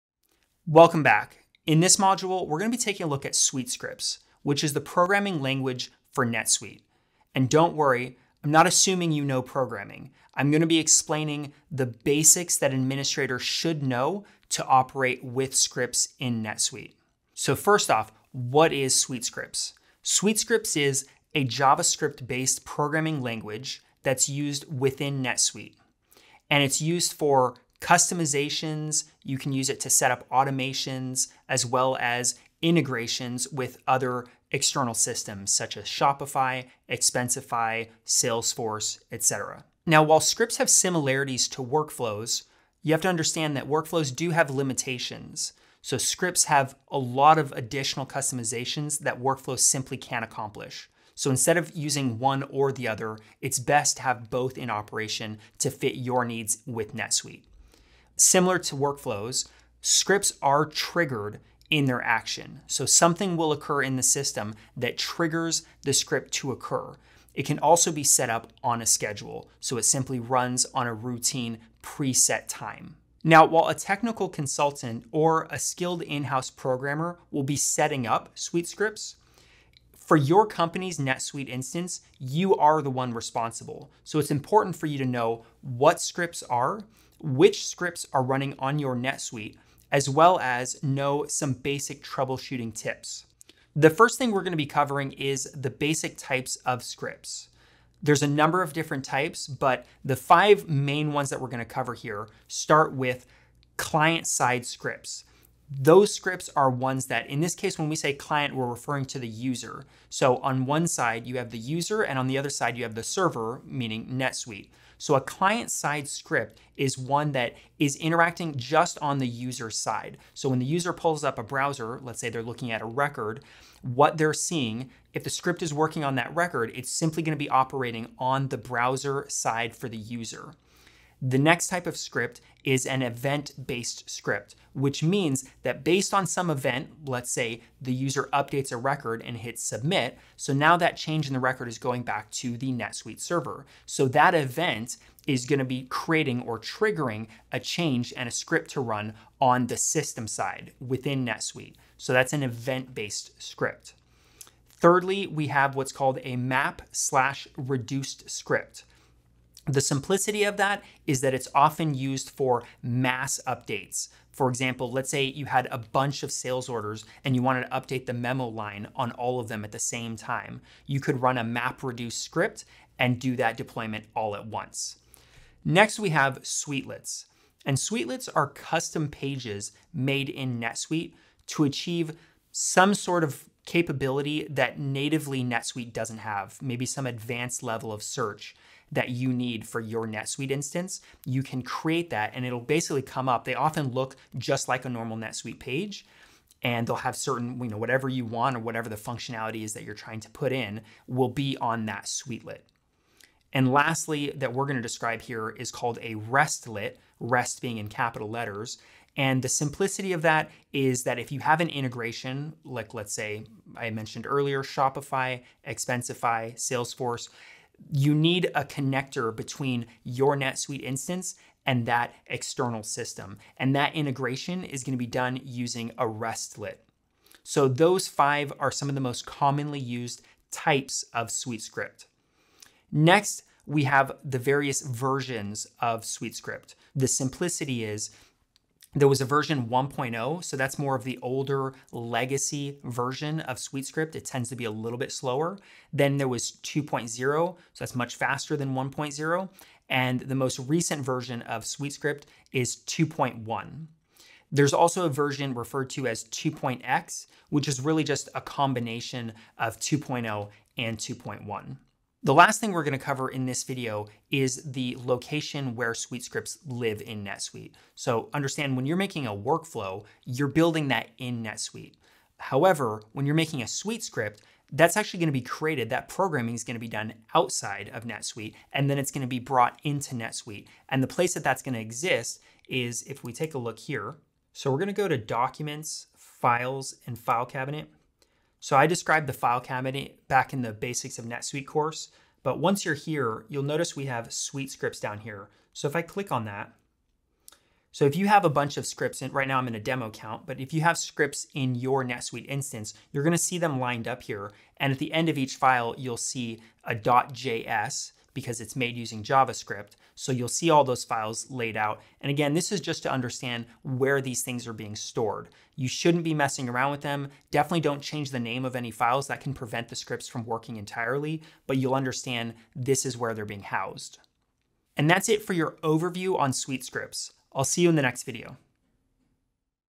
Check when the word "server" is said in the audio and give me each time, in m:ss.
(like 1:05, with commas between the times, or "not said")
1:53, 2:23.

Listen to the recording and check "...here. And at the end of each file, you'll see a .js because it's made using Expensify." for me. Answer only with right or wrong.
wrong.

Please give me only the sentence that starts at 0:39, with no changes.
Now, while scripts have similarities to workflows, you have to understand that workflows do have limitations.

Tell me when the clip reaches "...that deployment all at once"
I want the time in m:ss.
2:53.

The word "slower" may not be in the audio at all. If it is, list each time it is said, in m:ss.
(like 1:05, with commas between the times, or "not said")
4:05.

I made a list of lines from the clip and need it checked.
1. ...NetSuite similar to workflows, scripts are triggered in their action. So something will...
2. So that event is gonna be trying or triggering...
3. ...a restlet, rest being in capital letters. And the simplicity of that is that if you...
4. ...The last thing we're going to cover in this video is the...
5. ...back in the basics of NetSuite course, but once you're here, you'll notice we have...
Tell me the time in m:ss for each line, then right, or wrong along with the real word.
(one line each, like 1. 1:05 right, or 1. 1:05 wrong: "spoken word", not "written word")
1. 0:56 right
2. 2:23 wrong: "creating", not "trying"
3. 3:26 right
4. 4:22 right
5. 4:50 right.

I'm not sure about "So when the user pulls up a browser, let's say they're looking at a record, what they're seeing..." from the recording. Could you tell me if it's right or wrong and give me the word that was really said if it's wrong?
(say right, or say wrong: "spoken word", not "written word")
right.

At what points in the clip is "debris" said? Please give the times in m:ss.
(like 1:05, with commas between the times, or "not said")
not said.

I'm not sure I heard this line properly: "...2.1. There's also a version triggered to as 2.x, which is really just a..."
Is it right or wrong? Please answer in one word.
wrong.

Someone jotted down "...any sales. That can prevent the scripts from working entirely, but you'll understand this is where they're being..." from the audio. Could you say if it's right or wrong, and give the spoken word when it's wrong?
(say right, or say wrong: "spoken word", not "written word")
wrong: "files", not "sales".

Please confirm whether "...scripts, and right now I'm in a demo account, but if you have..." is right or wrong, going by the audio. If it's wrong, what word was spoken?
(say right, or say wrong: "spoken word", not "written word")
right.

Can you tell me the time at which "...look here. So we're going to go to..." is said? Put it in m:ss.
4:43.